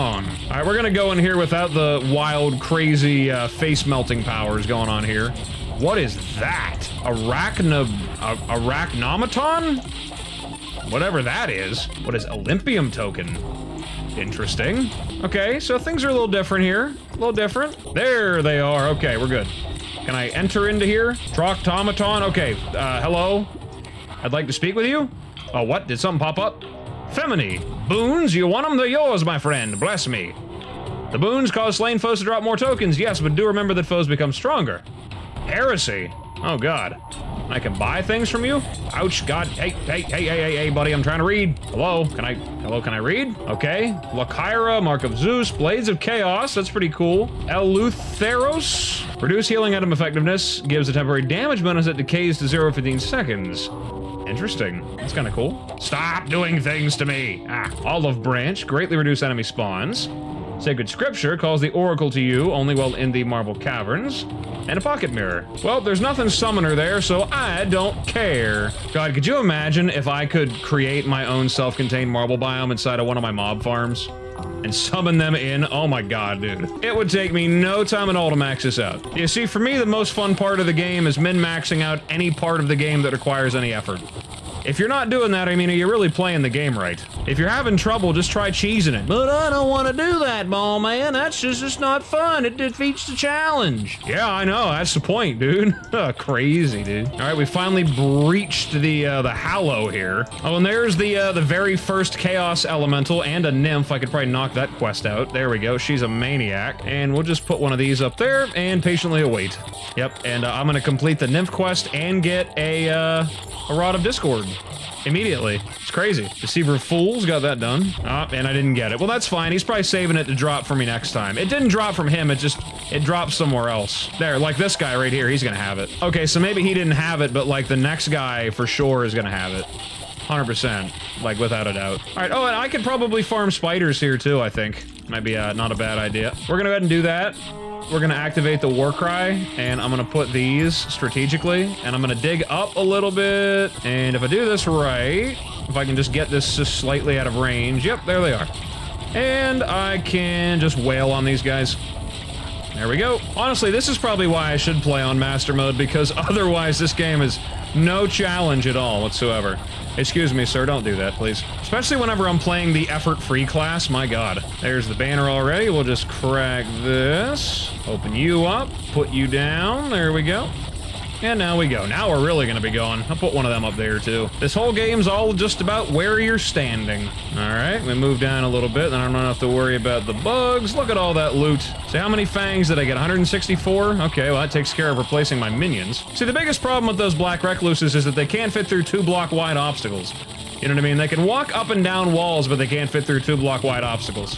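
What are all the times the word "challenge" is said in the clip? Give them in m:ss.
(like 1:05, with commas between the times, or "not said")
1:33, 2:38.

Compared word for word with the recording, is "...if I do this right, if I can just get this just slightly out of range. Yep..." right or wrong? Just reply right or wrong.
right.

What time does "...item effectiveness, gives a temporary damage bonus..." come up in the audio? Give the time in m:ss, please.
0:49.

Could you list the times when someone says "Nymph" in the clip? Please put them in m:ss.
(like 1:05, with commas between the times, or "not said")
1:43, 1:51.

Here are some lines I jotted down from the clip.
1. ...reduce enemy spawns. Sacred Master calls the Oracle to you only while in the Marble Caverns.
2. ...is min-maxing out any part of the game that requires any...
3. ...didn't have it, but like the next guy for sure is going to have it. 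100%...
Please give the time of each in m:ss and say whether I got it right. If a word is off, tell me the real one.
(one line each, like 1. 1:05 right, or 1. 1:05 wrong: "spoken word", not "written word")
1. 0:58 wrong: "Scripture", not "Master"
2. 1:21 right
3. 2:06 right.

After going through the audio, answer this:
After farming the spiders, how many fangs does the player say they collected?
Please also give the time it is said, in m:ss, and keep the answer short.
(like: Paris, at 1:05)
164, at 3:02.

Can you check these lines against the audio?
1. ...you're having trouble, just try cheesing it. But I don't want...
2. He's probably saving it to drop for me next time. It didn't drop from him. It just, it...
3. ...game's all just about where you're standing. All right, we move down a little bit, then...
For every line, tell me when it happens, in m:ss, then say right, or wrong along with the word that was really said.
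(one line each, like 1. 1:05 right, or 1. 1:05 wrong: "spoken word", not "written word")
1. 1:27 right
2. 1:59 right
3. 2:54 right.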